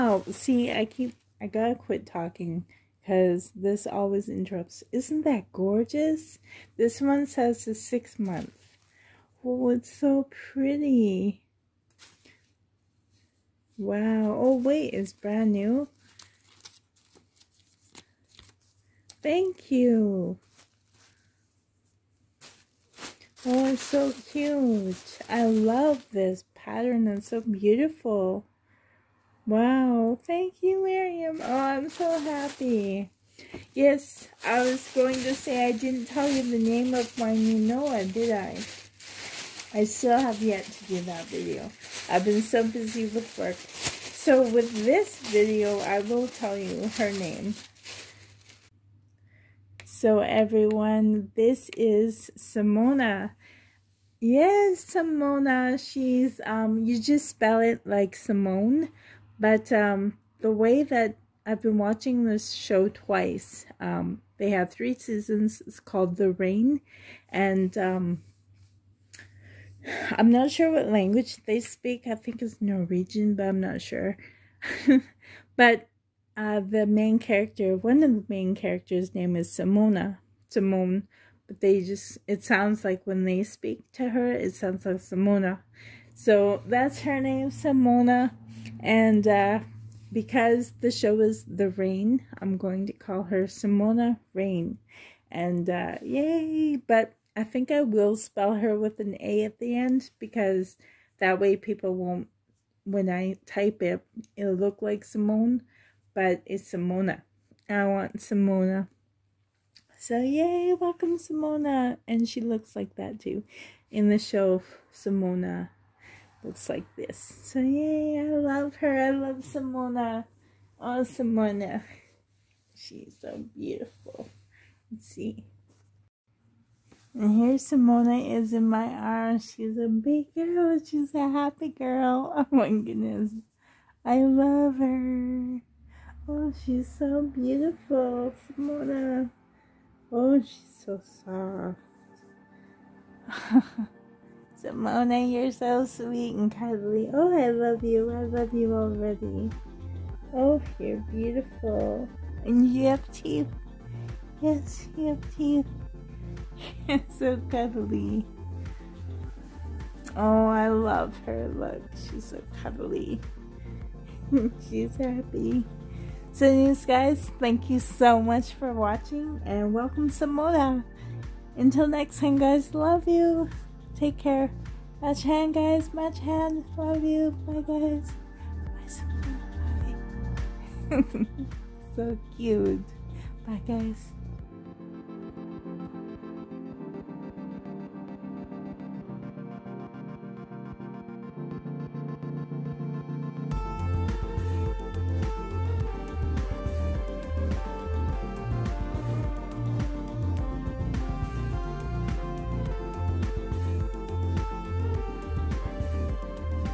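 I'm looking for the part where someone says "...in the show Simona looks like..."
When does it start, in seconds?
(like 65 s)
113 s.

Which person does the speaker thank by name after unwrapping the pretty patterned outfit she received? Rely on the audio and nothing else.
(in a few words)
Miriam.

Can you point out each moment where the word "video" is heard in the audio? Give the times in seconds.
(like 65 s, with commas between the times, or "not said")
41 s, 45 s.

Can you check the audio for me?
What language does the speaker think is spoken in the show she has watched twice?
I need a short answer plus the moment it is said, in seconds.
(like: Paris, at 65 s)
Norwegian, at 72 s.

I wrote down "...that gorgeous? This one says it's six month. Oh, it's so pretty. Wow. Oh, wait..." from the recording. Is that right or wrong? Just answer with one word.
right.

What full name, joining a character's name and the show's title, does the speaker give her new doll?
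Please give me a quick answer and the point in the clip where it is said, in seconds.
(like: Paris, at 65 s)
Simona Rain, at 93 s.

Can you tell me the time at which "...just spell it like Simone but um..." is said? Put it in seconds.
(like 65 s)
56 s.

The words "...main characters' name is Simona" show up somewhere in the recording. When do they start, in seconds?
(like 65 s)
78 s.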